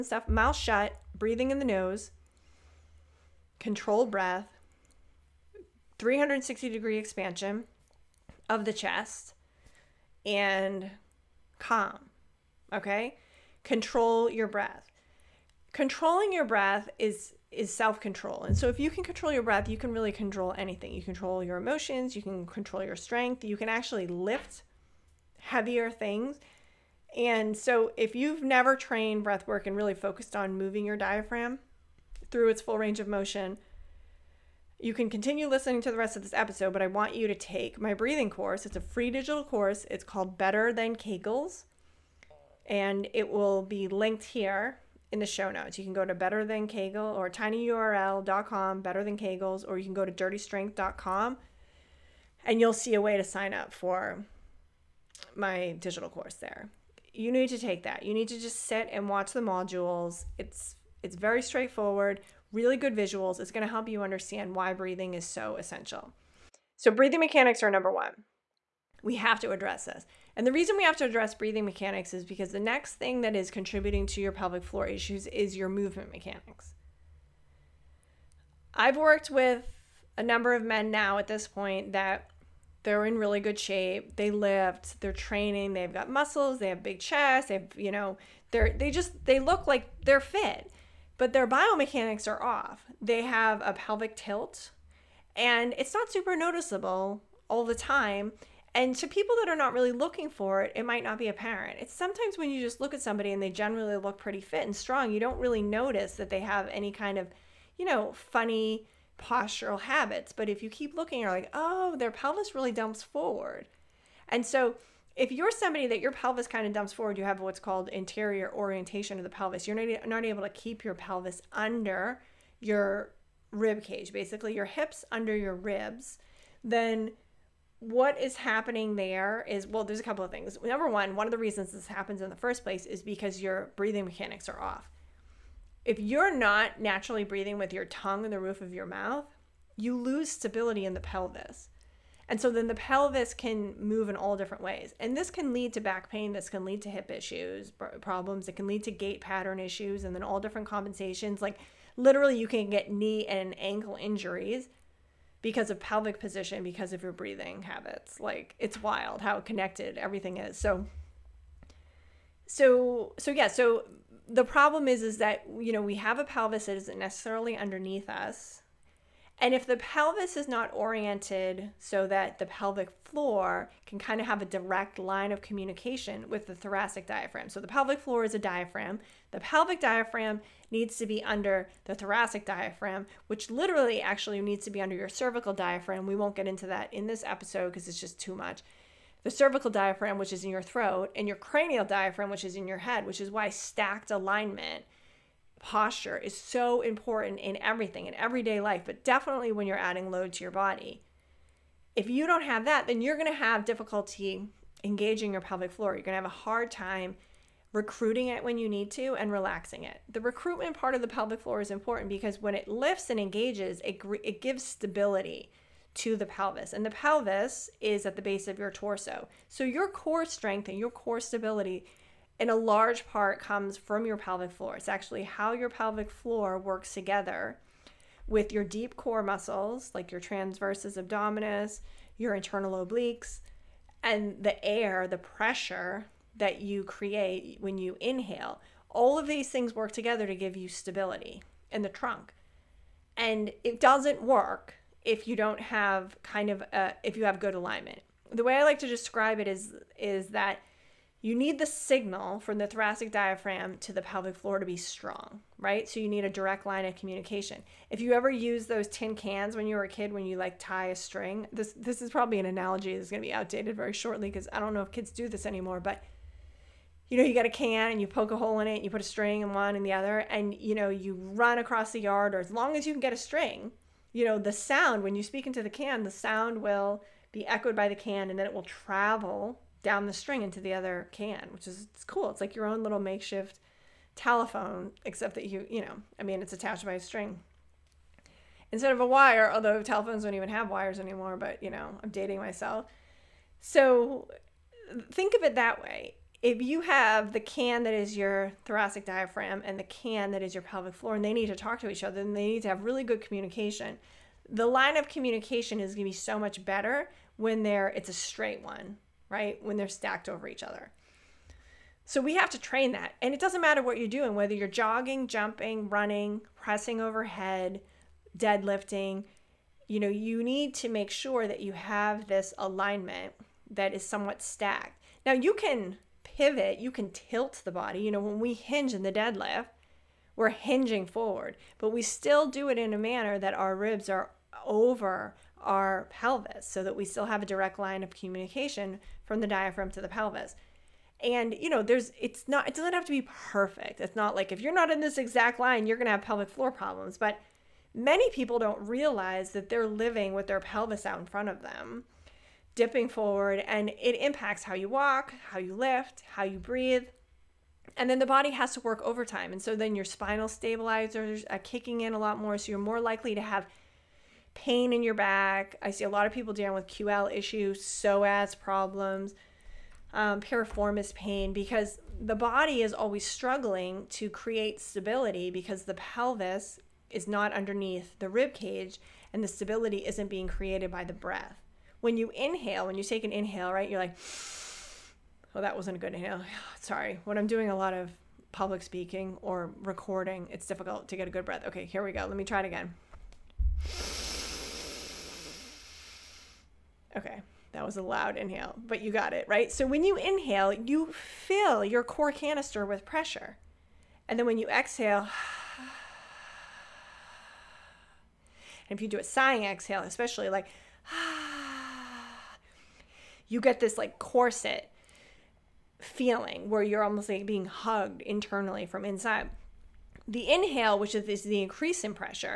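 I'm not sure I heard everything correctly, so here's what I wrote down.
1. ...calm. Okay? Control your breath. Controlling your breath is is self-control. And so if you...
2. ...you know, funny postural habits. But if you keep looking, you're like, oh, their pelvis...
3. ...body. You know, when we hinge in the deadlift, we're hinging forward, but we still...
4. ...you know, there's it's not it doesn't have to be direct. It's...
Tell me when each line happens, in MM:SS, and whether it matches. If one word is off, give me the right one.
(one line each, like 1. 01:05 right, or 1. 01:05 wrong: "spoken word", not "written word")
1. 00:11 right
2. 01:47 right
3. 05:27 right
4. 05:41 wrong: "perfect", not "direct".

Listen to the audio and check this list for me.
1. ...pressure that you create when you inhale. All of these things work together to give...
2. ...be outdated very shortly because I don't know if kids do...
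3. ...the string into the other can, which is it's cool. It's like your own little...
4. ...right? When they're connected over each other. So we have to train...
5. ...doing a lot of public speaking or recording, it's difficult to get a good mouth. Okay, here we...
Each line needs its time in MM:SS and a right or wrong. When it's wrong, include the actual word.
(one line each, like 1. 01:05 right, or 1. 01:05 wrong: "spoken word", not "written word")
1. 03:55 right
2. 04:23 right
3. 04:40 right
4. 05:09 wrong: "stacked", not "connected"
5. 06:27 wrong: "breath", not "mouth".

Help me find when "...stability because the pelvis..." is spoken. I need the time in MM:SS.
06:14.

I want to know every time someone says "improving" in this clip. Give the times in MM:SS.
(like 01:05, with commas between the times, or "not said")
not said.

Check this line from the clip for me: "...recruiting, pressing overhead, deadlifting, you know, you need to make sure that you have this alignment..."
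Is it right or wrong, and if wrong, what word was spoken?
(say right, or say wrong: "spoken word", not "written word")
wrong: "running", not "recruiting".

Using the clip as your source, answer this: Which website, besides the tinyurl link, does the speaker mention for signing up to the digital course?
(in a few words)
dirtystrength.com.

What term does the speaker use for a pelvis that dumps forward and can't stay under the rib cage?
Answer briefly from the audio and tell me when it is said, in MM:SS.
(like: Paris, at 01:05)
interior orientation, at 01:57.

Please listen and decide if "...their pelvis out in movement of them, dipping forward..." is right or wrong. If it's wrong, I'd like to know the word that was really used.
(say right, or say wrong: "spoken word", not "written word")
wrong: "front", not "movement".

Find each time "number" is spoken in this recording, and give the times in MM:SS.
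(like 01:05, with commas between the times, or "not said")
01:07, 01:20, 02:10.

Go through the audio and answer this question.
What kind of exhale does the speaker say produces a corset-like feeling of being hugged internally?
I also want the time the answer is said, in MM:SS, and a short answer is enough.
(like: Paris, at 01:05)
sighing exhale, at 06:49.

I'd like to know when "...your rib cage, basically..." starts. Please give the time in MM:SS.
02:02.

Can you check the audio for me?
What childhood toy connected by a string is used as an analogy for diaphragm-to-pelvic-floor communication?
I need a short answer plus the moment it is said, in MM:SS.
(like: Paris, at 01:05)
tin cans, at 04:18.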